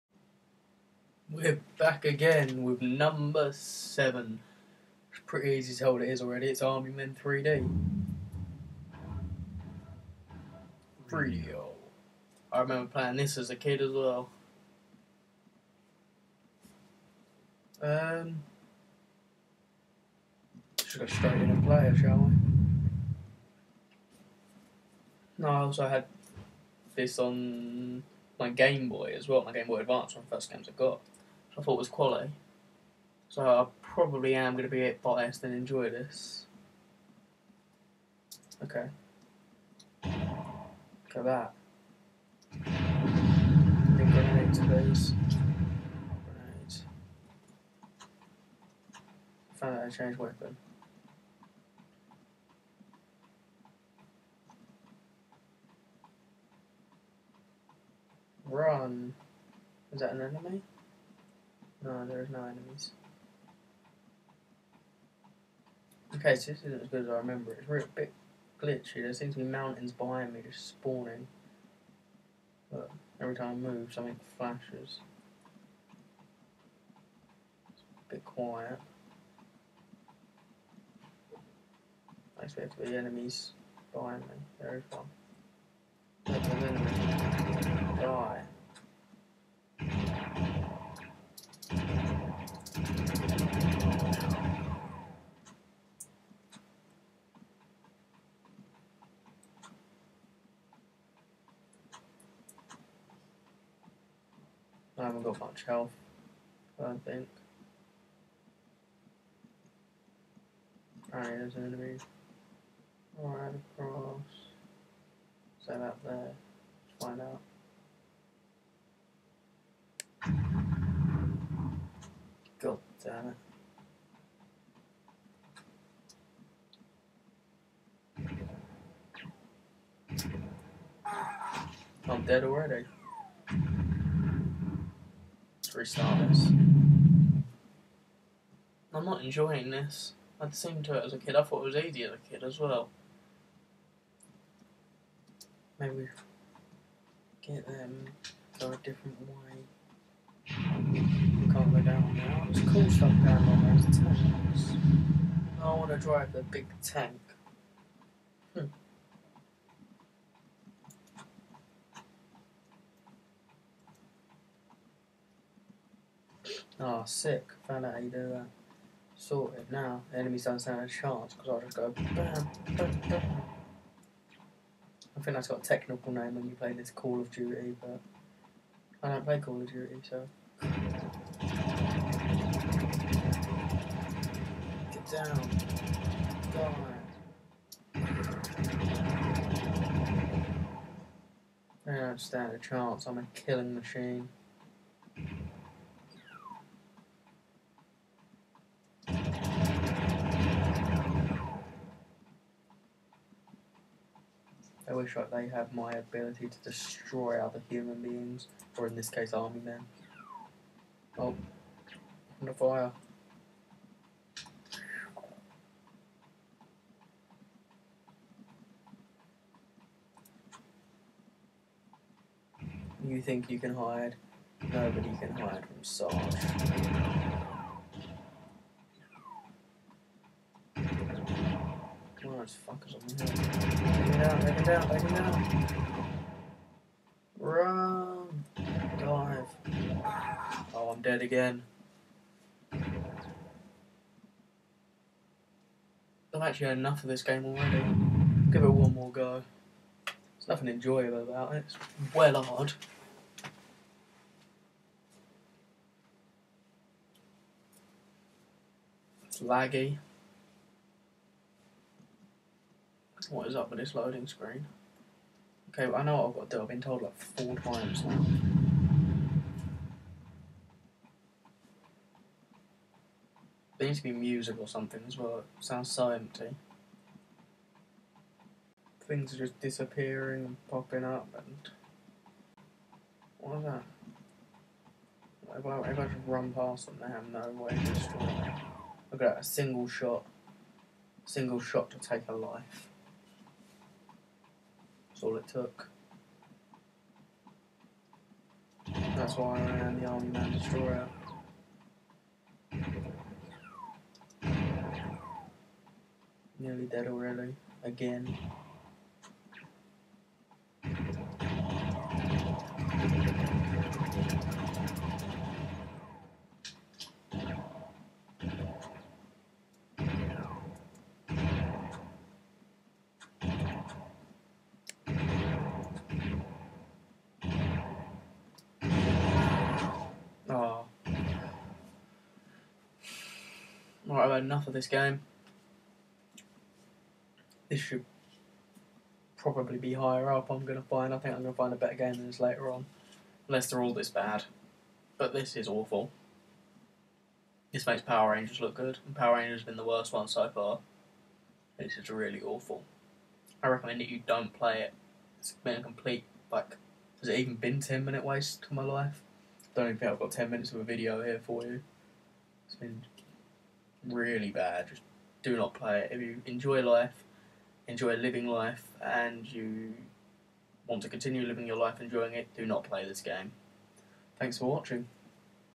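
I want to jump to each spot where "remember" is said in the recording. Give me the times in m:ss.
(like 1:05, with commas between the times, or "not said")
0:12, 1:07.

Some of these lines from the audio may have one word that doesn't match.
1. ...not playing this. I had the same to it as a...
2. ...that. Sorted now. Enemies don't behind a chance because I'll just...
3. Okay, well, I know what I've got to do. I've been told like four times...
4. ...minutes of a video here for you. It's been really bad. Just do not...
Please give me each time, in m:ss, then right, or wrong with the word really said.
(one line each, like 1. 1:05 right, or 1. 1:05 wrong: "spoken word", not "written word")
1. 2:19 wrong: "enjoying", not "playing"
2. 2:48 wrong: "stand", not "behind"
3. 4:25 right
4. 6:00 right.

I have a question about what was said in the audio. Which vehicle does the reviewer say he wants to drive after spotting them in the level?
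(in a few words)
the big tank.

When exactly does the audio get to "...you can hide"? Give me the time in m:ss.
3:43.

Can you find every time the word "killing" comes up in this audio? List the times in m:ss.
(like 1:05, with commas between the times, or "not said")
3:13.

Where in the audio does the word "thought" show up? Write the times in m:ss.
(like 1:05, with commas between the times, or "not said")
0:31, 2:21.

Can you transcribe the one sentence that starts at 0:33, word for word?
So I probably am going to be biased and enjoy this.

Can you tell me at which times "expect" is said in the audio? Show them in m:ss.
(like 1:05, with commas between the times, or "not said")
1:22.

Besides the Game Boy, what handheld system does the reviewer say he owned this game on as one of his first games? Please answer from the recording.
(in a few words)
Game Boy Advance.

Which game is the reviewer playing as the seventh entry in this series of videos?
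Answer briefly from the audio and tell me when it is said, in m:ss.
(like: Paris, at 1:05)
Army Men 3D, at 0:06.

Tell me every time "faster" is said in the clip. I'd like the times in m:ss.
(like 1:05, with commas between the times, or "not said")
not said.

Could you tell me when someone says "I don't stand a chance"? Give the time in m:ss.
3:11.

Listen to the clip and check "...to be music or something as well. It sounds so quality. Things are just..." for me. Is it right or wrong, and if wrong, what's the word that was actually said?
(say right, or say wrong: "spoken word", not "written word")
wrong: "empty", not "quality".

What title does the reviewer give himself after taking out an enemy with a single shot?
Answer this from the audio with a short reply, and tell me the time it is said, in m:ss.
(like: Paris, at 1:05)
Army Man Destroyer, at 5:00.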